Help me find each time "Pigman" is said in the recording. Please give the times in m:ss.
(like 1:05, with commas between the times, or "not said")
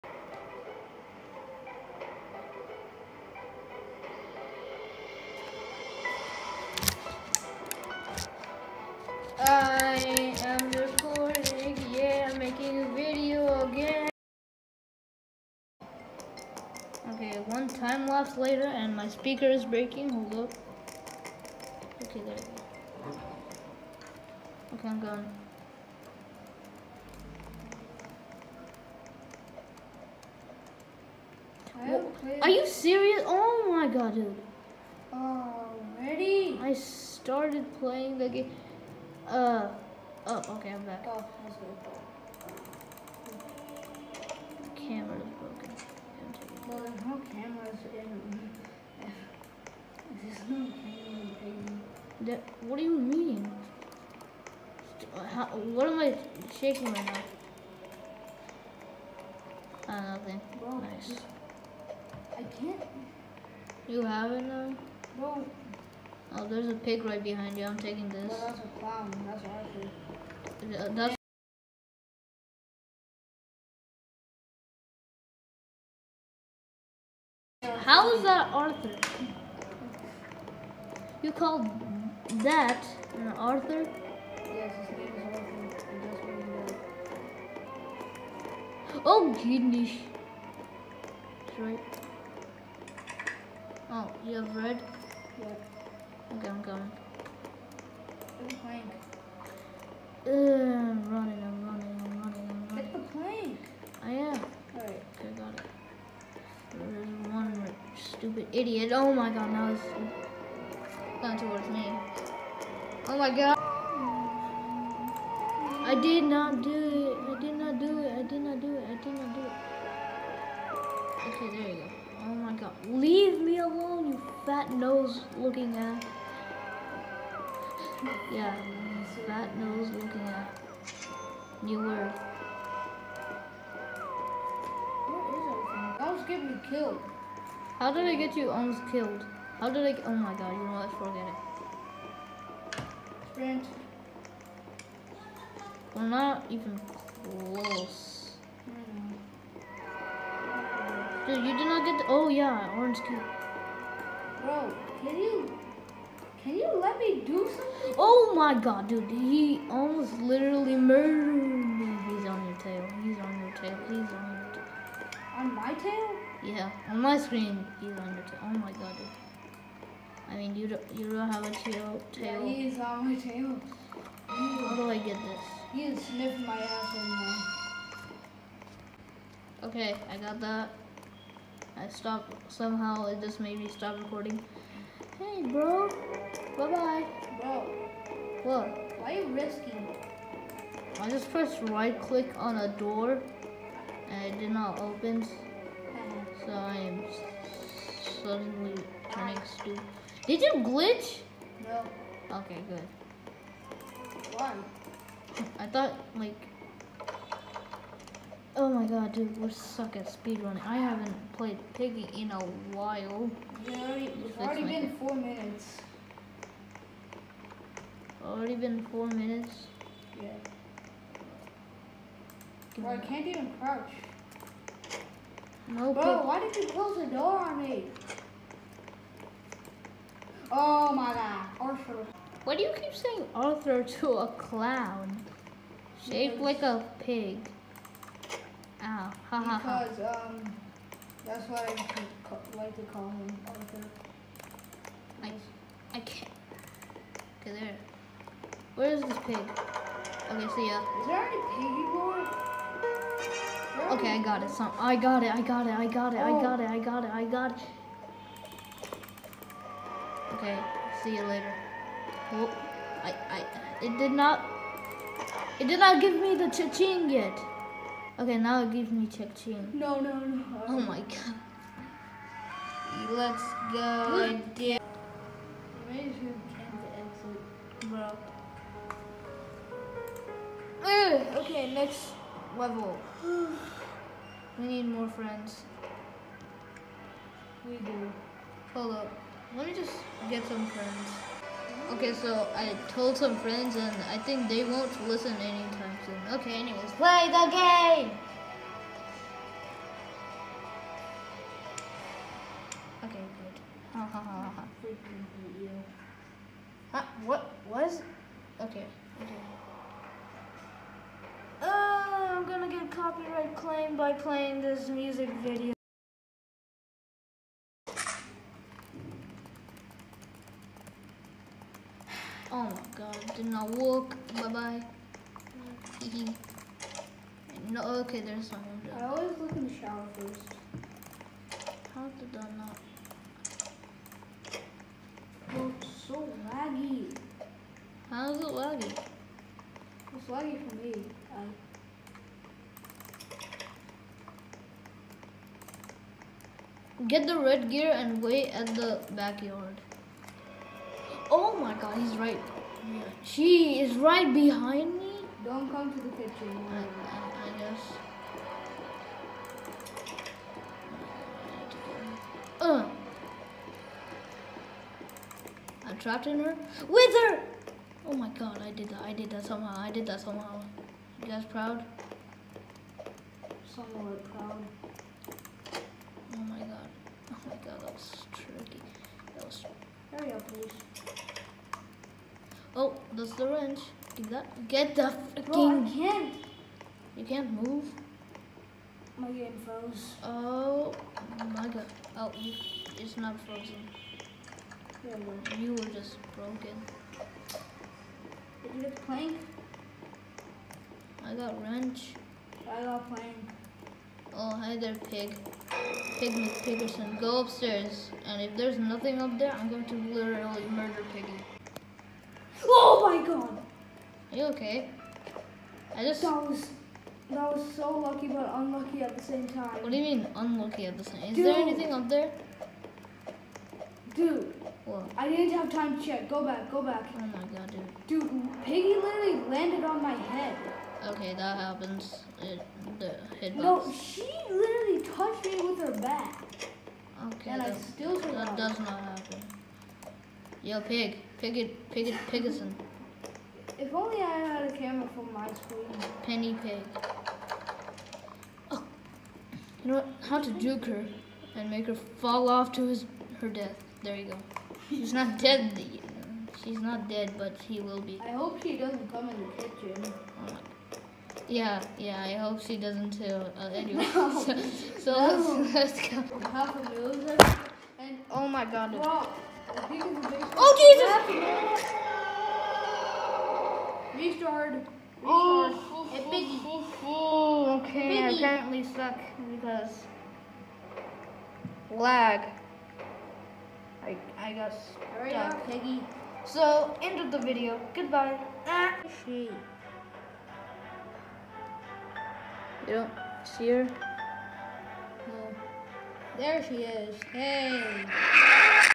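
6:46.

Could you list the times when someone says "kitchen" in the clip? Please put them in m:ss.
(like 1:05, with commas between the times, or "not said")
5:56, 7:39.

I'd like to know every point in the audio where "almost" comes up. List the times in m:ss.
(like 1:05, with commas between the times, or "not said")
2:18, 2:39.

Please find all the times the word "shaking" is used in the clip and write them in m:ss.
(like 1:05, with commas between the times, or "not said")
0:56.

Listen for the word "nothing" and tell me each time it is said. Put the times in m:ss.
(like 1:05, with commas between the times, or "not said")
1:00, 6:48.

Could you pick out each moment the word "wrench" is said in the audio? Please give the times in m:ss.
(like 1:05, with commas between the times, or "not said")
6:23, 6:41.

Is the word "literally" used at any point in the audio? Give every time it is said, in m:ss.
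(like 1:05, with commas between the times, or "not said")
2:40, 6:49, 7:08, 7:14.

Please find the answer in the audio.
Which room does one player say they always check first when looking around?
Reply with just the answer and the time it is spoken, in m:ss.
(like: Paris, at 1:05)
the shower, at 5:28.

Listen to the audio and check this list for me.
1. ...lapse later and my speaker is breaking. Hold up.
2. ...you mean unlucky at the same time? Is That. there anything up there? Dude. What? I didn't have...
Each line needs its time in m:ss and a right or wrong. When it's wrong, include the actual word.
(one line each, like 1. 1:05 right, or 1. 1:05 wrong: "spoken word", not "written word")
1. 0:18 right
2. 6:59 wrong: "Dude", not "That".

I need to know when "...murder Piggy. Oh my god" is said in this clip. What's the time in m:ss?
6:50.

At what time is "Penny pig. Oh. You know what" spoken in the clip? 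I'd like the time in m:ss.
7:26.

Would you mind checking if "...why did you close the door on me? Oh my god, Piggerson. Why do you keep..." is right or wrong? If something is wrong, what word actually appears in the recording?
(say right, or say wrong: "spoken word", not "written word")
wrong: "Arthur", not "Piggerson".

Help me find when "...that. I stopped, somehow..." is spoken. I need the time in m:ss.
3:00.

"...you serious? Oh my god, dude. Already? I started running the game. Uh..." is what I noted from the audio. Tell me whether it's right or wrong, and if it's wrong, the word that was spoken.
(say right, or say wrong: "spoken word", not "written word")
wrong: "playing", not "running".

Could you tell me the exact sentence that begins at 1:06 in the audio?
Oh, there's a pig right behind you.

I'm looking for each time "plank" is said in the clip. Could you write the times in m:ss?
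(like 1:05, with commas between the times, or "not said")
6:39, 6:43.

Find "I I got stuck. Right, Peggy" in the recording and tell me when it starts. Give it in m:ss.
8:04.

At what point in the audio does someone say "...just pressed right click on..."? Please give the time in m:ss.
3:11.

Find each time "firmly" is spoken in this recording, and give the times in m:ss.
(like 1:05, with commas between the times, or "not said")
not said.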